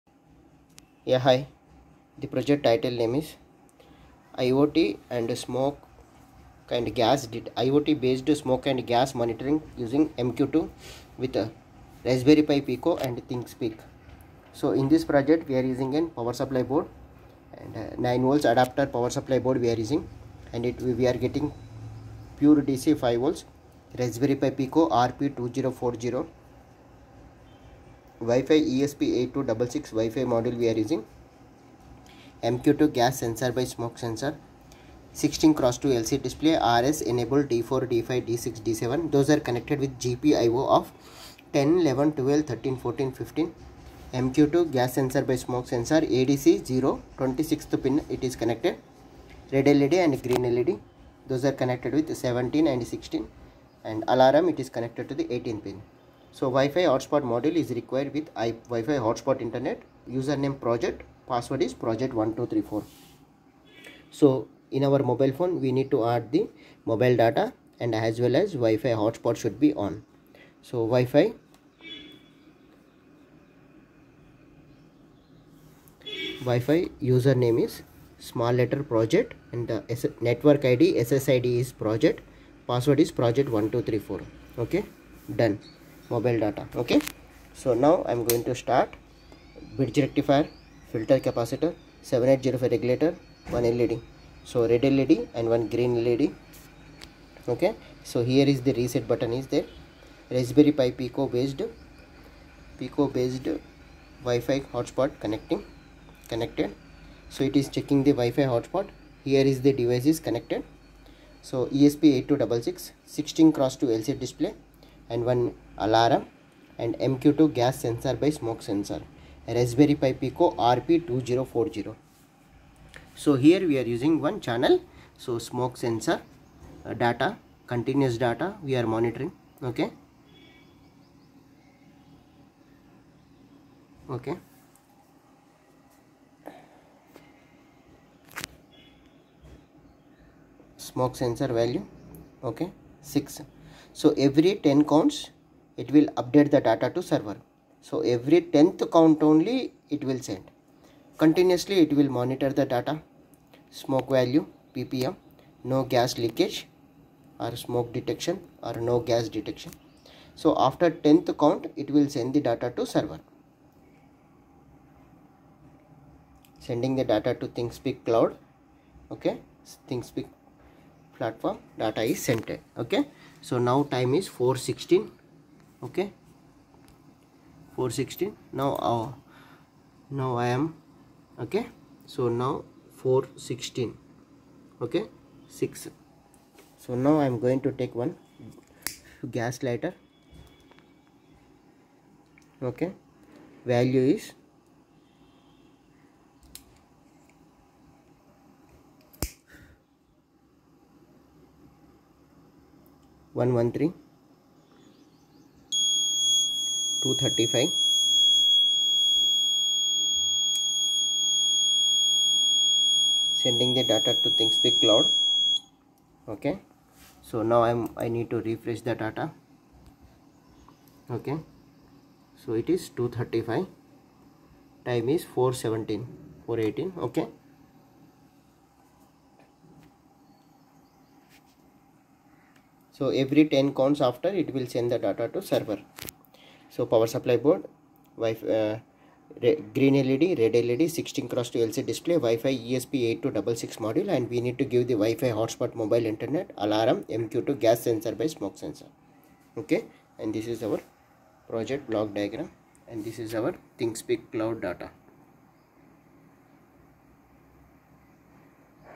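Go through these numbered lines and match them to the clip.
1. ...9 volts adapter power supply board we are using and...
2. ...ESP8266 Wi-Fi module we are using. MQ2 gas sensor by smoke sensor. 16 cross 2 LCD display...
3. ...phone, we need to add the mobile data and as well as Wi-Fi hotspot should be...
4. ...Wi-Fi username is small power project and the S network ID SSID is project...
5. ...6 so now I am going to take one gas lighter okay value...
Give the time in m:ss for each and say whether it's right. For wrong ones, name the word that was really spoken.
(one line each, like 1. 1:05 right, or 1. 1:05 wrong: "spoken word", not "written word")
1. 0:17 right
2. 0:28 right
3. 1:05 right
4. 1:16 wrong: "letter", not "power"
5. 3:05 right.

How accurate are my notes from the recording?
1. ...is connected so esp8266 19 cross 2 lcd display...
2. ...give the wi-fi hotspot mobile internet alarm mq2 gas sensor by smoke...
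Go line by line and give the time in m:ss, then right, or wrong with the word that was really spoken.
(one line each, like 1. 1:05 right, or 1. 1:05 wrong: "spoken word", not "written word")
1. 1:50 wrong: "16", not "19"
2. 4:04 right.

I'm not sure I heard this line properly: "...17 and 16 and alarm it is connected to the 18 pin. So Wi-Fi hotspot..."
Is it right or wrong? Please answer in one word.
right.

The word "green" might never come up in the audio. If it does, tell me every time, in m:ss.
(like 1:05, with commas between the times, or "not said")
0:50, 1:35, 3:59.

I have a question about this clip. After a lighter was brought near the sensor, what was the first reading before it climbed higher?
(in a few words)
113.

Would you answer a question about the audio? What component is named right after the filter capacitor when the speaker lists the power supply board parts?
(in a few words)
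7805 regulator.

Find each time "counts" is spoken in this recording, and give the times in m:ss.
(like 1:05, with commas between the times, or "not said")
2:24, 2:28, 2:41, 3:53.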